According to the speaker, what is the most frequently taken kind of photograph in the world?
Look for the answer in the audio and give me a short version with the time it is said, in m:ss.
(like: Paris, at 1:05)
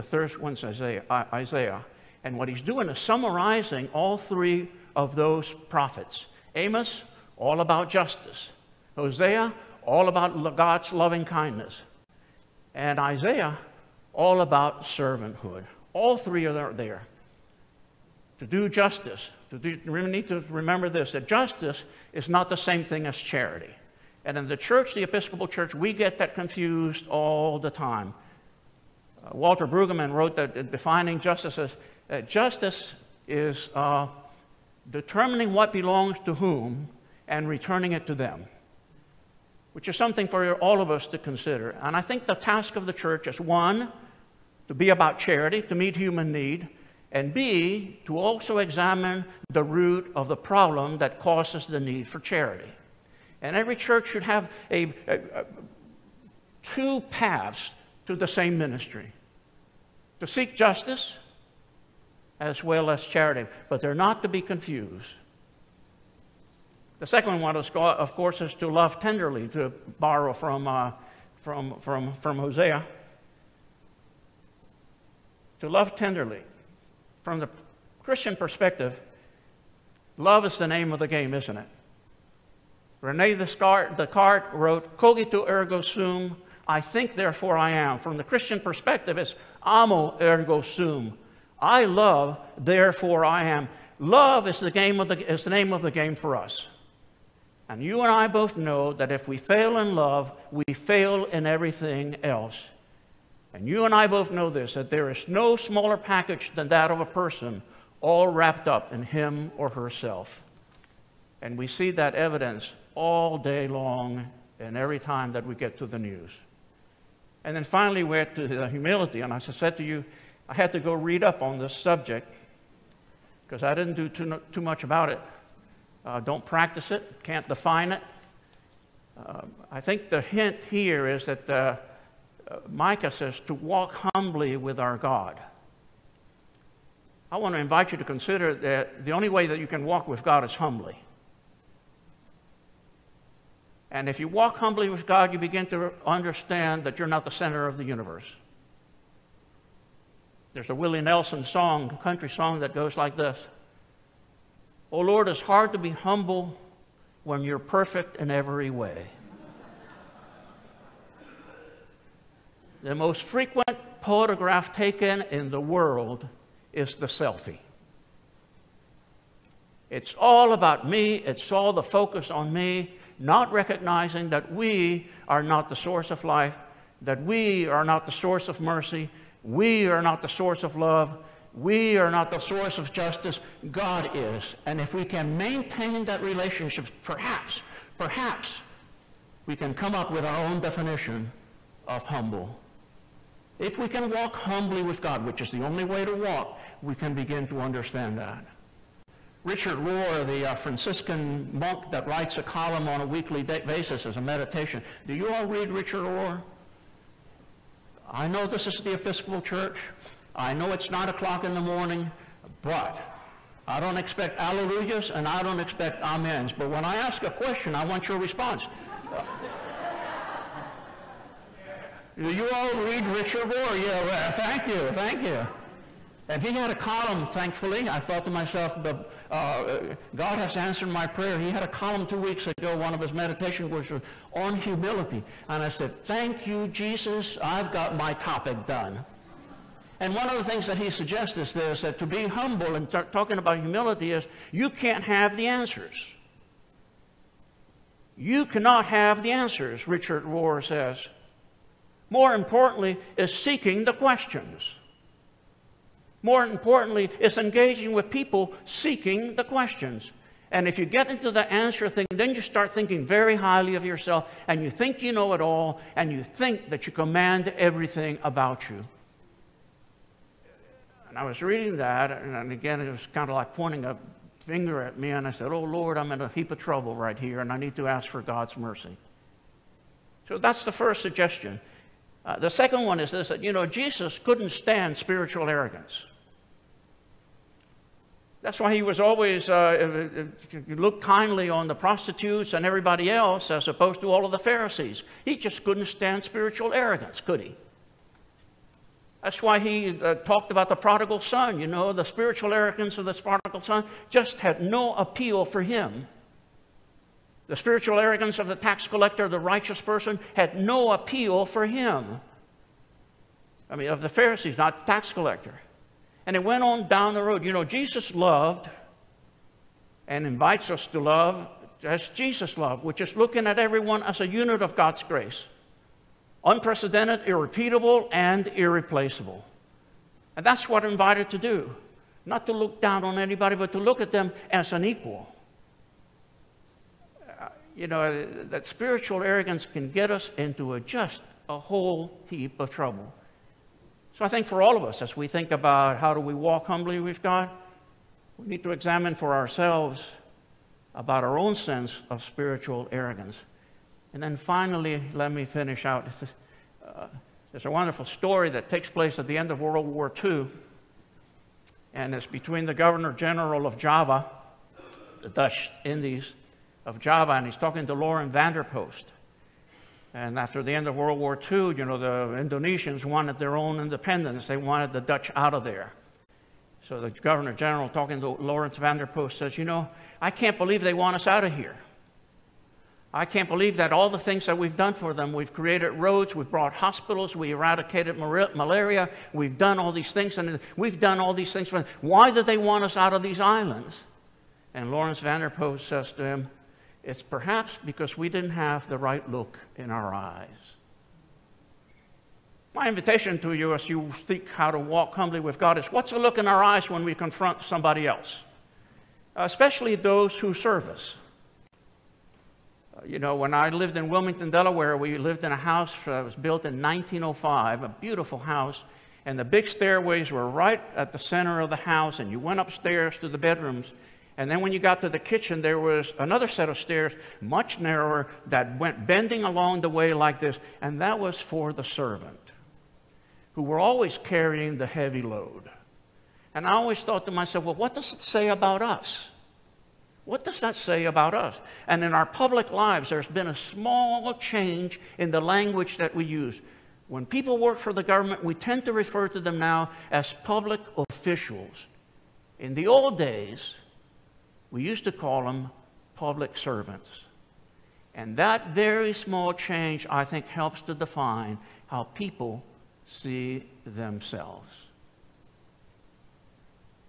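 the selfie, at 2:46.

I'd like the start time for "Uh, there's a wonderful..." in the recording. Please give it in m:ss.
5:56.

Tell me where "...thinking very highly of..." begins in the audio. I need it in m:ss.
4:22.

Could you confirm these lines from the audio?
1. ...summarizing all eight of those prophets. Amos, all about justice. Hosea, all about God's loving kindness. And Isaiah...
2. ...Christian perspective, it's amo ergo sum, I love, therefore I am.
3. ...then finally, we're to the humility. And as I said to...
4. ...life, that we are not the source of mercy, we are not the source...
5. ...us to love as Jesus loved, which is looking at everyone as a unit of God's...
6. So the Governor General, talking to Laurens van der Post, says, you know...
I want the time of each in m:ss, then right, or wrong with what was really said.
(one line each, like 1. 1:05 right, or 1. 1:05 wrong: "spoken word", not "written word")
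1. 0:02 wrong: "three", not "eight"
2. 1:28 right
3. 1:57 right
4. 2:56 right
5. 5:20 right
6. 6:16 right.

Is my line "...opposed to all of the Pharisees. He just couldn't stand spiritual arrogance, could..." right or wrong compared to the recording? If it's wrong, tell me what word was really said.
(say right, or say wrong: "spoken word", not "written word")
right.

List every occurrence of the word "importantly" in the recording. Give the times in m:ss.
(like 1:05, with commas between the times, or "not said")
4:12, 4:16.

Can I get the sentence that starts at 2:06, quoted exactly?
Uh, don't practice it, can't define it.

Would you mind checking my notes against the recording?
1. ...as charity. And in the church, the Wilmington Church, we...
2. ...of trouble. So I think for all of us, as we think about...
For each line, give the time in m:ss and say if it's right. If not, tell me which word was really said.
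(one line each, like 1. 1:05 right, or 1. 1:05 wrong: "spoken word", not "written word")
1. 0:23 wrong: "Episcopal", not "Wilmington"
2. 5:42 right.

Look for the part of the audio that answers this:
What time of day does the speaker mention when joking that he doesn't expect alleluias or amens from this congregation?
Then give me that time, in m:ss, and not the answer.
3:30.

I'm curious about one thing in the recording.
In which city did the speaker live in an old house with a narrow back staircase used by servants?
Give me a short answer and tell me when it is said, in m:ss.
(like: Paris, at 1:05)
Wilmington, Delaware, at 6:54.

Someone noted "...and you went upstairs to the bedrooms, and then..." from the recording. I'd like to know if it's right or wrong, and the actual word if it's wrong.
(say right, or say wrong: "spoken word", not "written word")
right.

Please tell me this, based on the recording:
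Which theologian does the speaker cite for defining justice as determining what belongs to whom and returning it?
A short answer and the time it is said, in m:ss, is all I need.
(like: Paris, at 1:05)
Walter Brueggemann, at 0:29.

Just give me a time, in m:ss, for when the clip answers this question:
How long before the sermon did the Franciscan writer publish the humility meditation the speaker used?
3:52.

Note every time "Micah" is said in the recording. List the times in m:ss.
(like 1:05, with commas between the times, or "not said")
2:12.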